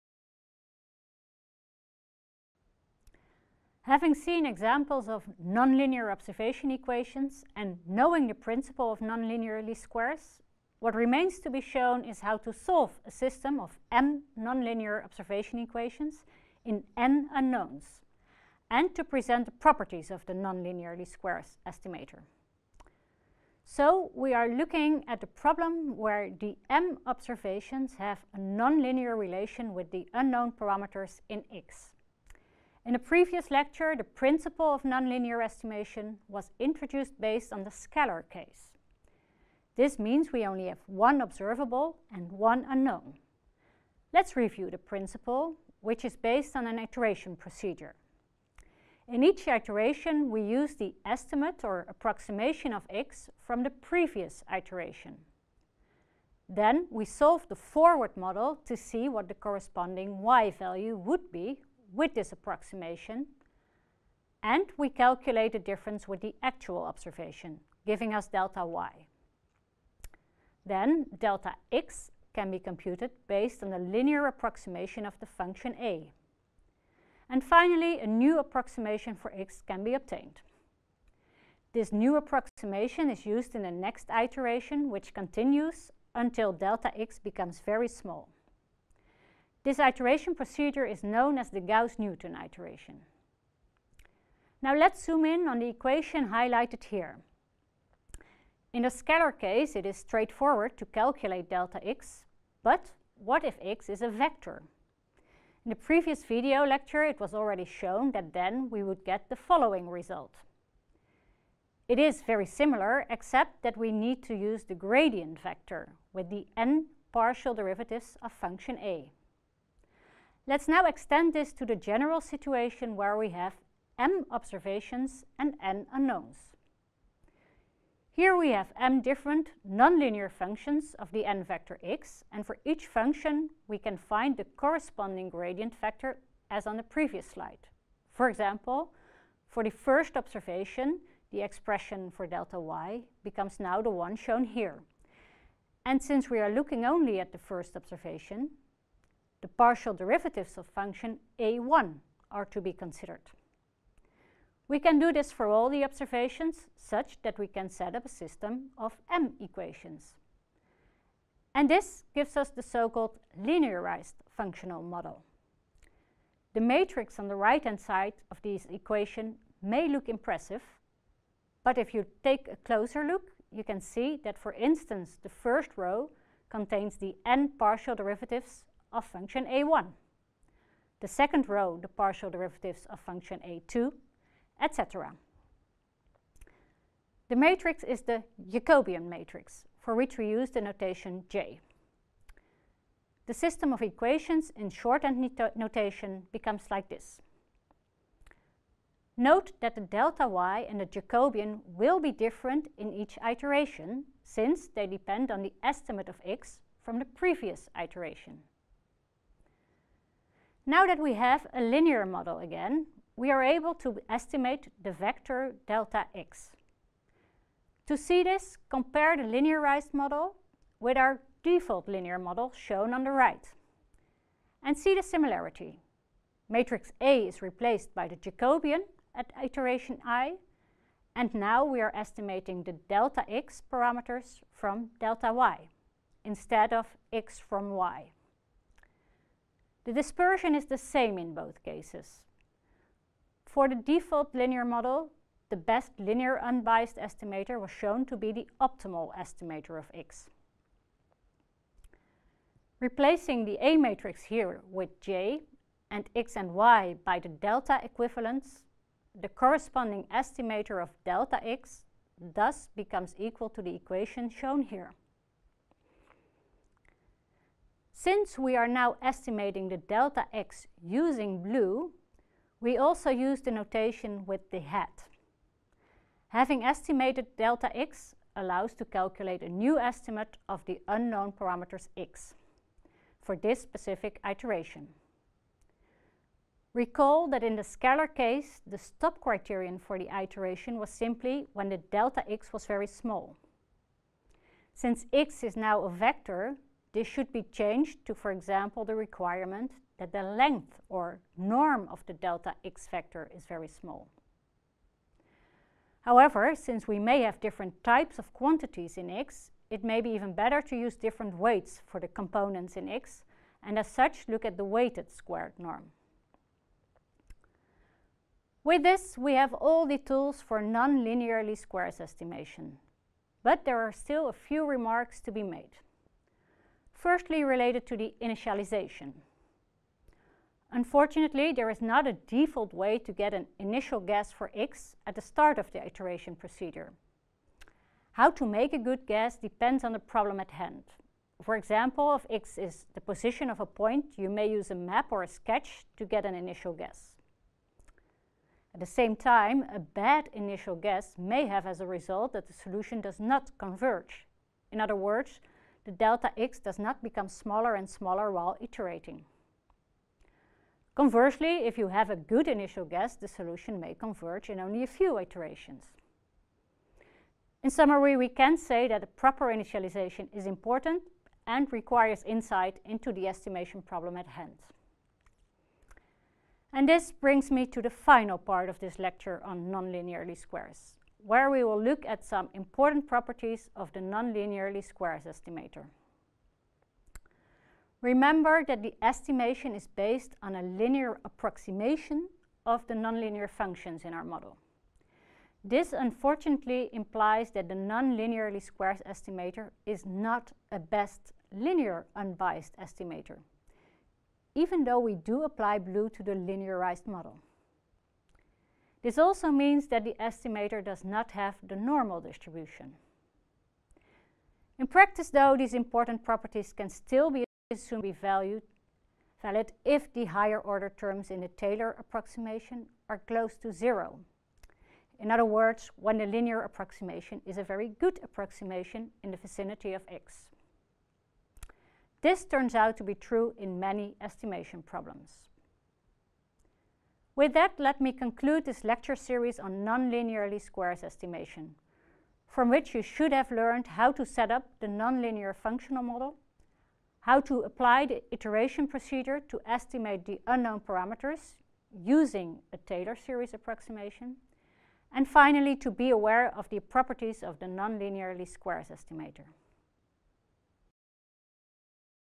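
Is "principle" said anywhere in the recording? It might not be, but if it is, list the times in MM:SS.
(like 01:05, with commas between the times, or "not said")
00:08, 00:34, 00:44.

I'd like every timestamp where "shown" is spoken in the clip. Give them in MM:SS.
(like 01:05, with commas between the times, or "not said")
00:11, 01:47, 02:24, 03:42, 04:07, 04:24.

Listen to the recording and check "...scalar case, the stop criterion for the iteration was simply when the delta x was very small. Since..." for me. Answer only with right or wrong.
right.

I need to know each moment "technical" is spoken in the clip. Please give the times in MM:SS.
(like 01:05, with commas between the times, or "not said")
not said.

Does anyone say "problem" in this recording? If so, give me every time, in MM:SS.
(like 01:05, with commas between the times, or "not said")
00:25, 05:40, 06:13, 07:14.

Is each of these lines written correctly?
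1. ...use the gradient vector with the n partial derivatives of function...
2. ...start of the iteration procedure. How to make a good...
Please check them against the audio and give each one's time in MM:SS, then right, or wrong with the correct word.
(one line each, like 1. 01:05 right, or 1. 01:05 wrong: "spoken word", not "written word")
1. 01:54 right
2. 05:35 right.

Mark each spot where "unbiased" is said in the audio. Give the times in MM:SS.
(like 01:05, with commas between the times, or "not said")
04:06, 06:42.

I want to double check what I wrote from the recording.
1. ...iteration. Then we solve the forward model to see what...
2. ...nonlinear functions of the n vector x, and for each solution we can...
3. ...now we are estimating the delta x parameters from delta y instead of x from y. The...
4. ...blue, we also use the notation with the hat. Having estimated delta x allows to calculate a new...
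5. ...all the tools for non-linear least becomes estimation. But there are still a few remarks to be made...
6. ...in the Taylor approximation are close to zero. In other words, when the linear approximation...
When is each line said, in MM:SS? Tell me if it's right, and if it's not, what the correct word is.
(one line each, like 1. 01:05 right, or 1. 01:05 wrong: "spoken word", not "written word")
1. 00:54 right
2. 02:09 wrong: "function", not "solution"
3. 03:51 right
4. 04:31 right
5. 05:19 wrong: "squares", not "becomes"
6. 07:01 right.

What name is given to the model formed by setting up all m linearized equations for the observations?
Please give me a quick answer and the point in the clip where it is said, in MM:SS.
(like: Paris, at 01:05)
Linearized functional model, at 02:43.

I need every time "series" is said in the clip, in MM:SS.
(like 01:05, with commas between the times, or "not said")
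07:19, 07:33.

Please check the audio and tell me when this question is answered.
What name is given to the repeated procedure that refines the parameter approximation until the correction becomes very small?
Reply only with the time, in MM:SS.
01:31.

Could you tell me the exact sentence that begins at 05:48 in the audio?
At the same time, a bad initial guess may have as a result that the solution does not converge.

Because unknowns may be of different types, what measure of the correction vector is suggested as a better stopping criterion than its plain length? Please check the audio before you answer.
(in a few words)
Weighted squared norm.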